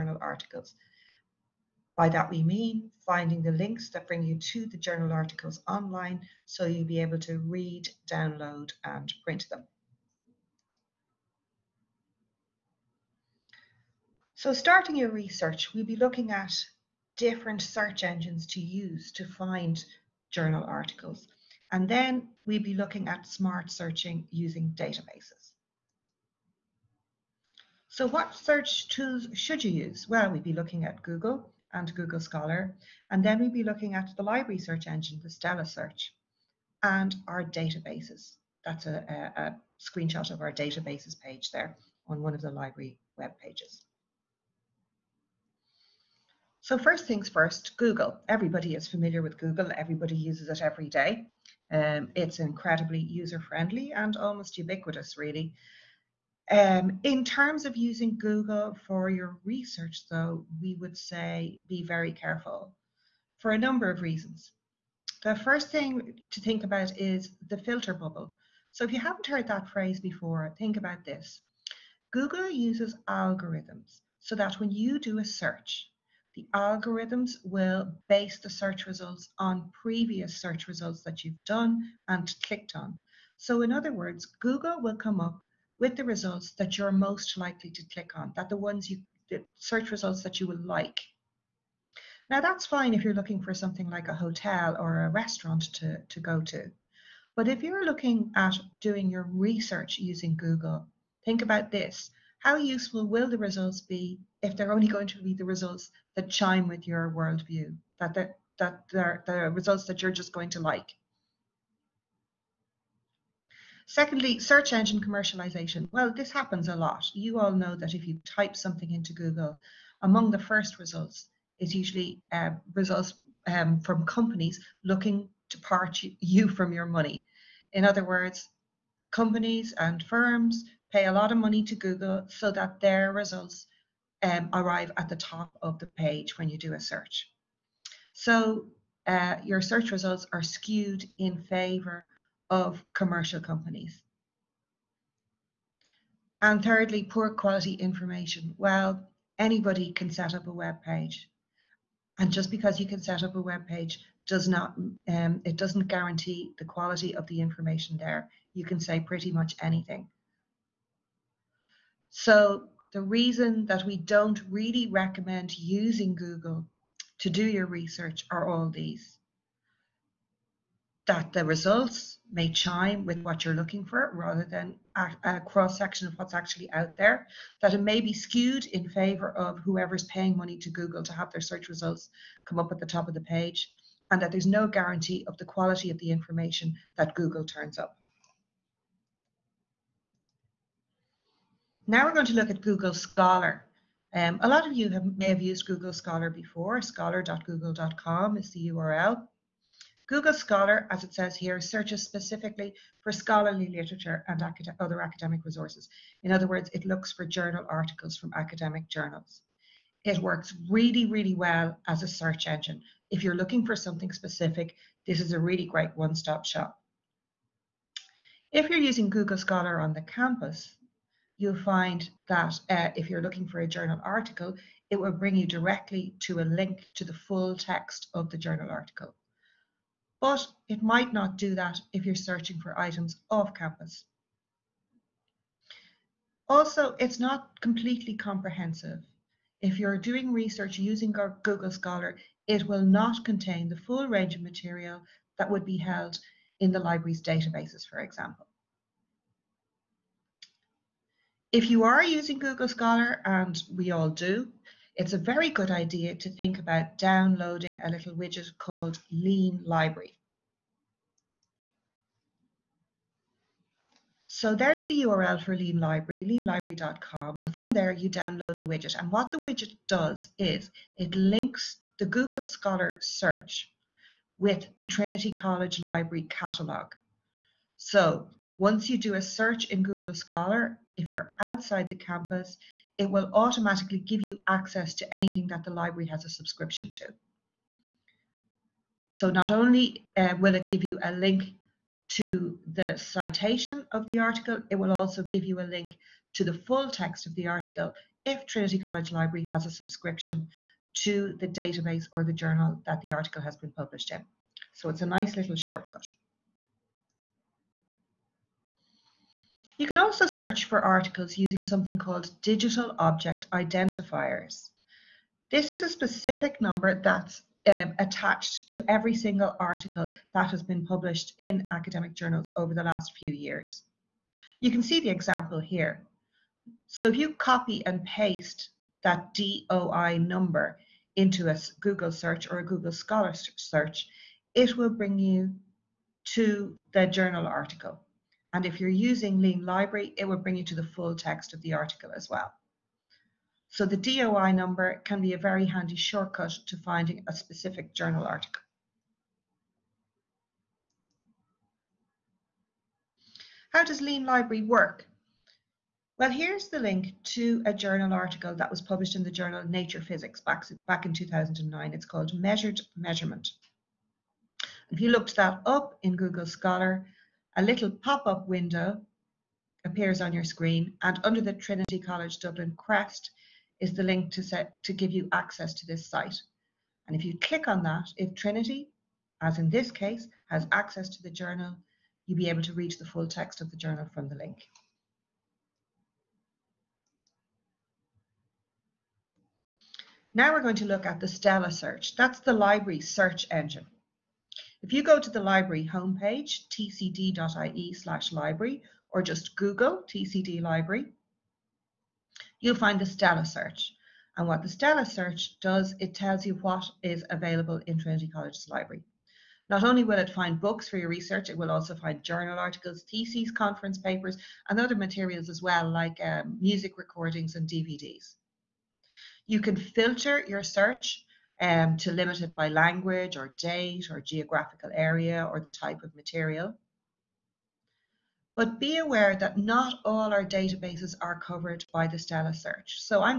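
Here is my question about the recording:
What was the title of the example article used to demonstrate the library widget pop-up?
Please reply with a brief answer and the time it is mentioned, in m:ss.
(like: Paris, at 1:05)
Measured Measurement, at 6:02.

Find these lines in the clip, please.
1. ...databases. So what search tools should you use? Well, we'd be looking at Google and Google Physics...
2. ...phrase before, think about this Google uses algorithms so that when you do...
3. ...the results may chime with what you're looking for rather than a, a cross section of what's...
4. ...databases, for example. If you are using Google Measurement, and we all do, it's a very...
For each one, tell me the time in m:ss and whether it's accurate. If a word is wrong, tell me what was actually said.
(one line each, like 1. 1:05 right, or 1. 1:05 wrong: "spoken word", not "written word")
1. 0:24 wrong: "Scholar", not "Physics"
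2. 1:09 right
3. 2:51 right
4. 4:07 wrong: "Scholar", not "Measurement".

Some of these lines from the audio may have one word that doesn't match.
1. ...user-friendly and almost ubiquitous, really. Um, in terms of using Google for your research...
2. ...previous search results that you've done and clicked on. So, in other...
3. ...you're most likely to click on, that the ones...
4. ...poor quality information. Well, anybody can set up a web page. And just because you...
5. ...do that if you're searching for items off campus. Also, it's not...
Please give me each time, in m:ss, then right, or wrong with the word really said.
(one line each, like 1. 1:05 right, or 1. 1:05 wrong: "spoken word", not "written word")
1. 0:52 right
2. 1:19 right
3. 1:26 right
4. 2:27 right
5. 3:51 right.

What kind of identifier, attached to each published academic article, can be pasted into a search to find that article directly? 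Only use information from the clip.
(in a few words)
Digital object identifiers.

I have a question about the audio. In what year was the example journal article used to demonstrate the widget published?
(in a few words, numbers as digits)
2009.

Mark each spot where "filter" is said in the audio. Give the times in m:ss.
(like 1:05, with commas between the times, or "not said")
1:07, 6:59.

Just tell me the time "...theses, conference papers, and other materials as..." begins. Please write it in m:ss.
6:53.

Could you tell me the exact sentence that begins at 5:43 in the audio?
So the DOI number can be a very handy shortcut to finding a specific journal article.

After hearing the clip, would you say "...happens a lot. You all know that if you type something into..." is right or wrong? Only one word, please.
right.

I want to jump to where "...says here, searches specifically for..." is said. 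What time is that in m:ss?
3:21.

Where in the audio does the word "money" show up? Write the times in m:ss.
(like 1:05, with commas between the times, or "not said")
2:06, 2:11, 3:00.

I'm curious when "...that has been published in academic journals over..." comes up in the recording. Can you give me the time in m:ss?
5:20.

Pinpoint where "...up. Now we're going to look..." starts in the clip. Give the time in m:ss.
3:07.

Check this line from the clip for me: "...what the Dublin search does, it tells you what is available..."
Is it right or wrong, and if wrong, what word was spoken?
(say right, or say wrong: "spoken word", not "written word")
wrong: "Stella", not "Dublin".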